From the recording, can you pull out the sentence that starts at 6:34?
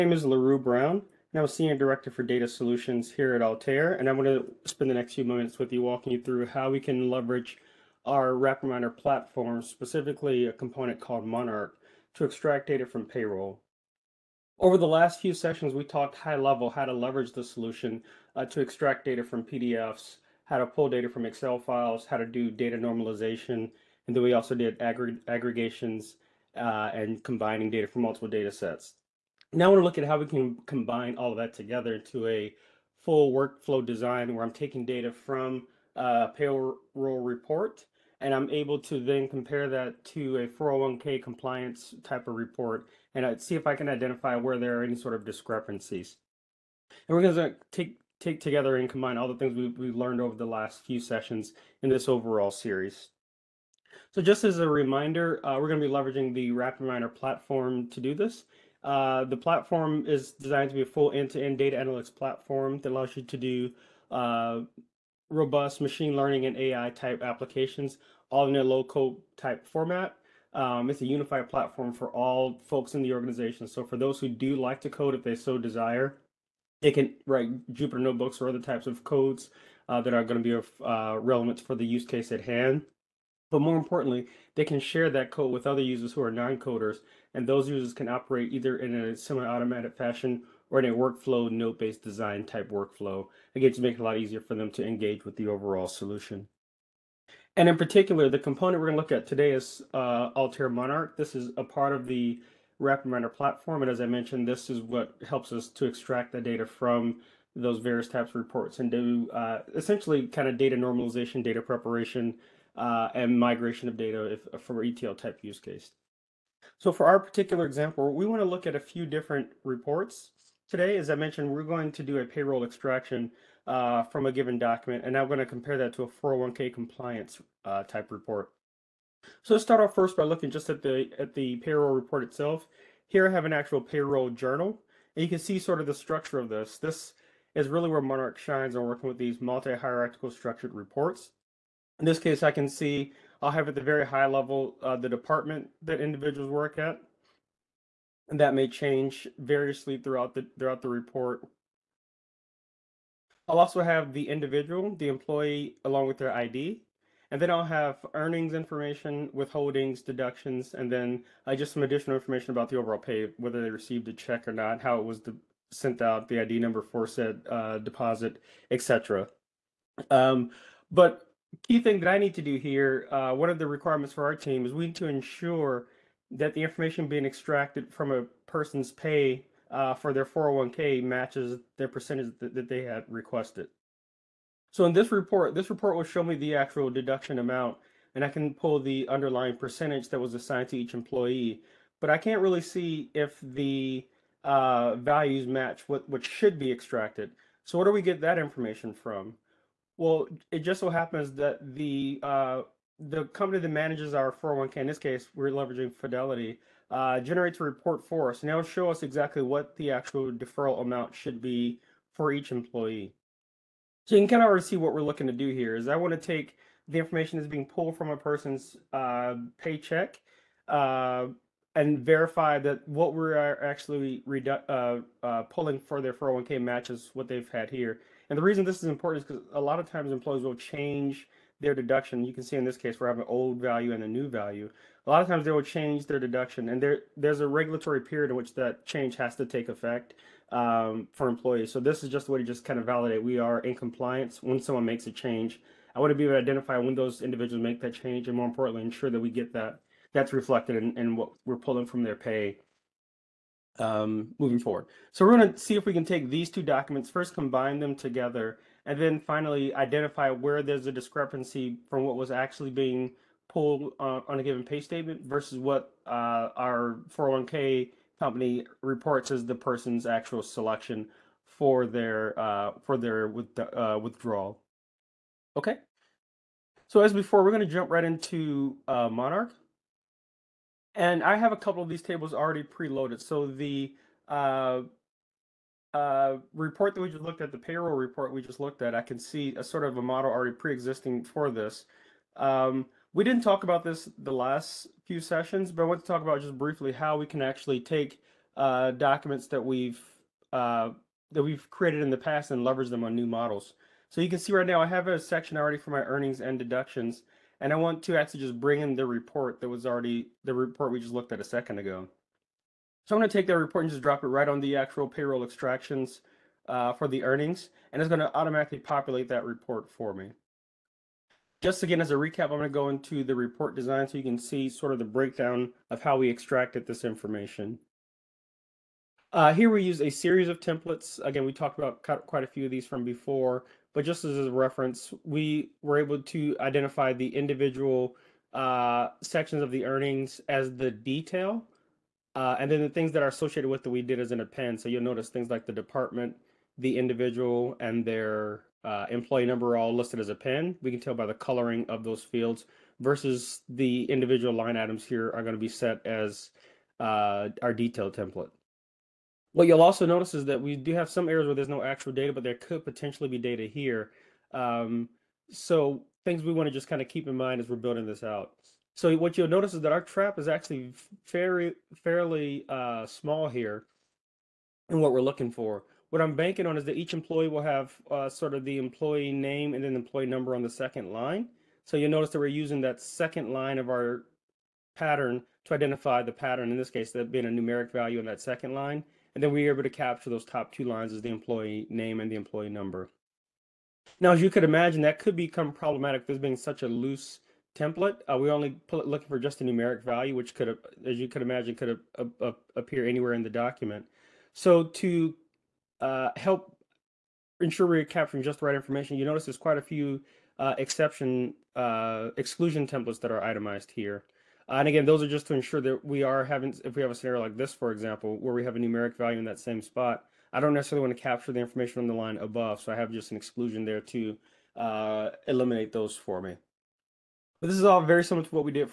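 Now, as you could imagine, that could become problematic this being such a loose template.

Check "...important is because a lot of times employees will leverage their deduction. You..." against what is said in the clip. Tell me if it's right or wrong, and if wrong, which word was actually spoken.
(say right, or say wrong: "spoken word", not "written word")
wrong: "change", not "leverage".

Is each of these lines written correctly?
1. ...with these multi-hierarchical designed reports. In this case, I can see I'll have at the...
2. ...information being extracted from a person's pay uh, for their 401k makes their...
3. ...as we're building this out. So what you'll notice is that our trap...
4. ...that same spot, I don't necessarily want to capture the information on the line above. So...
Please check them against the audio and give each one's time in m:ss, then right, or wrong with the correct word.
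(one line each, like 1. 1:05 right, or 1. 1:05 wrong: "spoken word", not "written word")
1. 2:19 wrong: "structured", not "designed"
2. 2:56 wrong: "matches", not "makes"
3. 6:07 right
4. 6:59 right.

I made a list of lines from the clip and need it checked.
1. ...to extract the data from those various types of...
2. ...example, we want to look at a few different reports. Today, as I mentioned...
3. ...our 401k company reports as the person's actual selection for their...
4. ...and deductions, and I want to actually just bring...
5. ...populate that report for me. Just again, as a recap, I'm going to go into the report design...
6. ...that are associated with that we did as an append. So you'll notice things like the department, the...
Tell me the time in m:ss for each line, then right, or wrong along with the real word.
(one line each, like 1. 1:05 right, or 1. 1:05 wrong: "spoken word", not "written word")
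1. 1:45 right
2. 1:57 right
3. 4:26 right
4. 5:06 right
5. 5:18 right
6. 5:43 right.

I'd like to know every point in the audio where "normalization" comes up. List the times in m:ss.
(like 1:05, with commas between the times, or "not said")
0:22, 1:50.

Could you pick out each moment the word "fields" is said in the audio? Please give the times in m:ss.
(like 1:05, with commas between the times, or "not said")
5:52.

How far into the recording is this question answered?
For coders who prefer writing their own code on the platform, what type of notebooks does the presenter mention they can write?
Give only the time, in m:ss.
1:17.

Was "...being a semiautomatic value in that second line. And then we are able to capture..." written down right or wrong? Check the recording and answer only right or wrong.
wrong.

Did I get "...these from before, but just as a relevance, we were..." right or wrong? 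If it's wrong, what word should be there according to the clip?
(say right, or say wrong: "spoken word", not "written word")
wrong: "reference", not "relevance".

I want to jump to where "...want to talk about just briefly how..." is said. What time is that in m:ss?
4:55.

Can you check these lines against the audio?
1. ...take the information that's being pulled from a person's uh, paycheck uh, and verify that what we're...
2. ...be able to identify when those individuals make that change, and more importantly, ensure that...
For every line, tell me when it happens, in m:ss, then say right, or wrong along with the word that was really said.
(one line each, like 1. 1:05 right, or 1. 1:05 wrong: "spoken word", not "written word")
1. 3:36 right
2. 4:06 right.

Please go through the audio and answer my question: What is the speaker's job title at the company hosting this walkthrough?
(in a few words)
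Senior Director for Data Solutions.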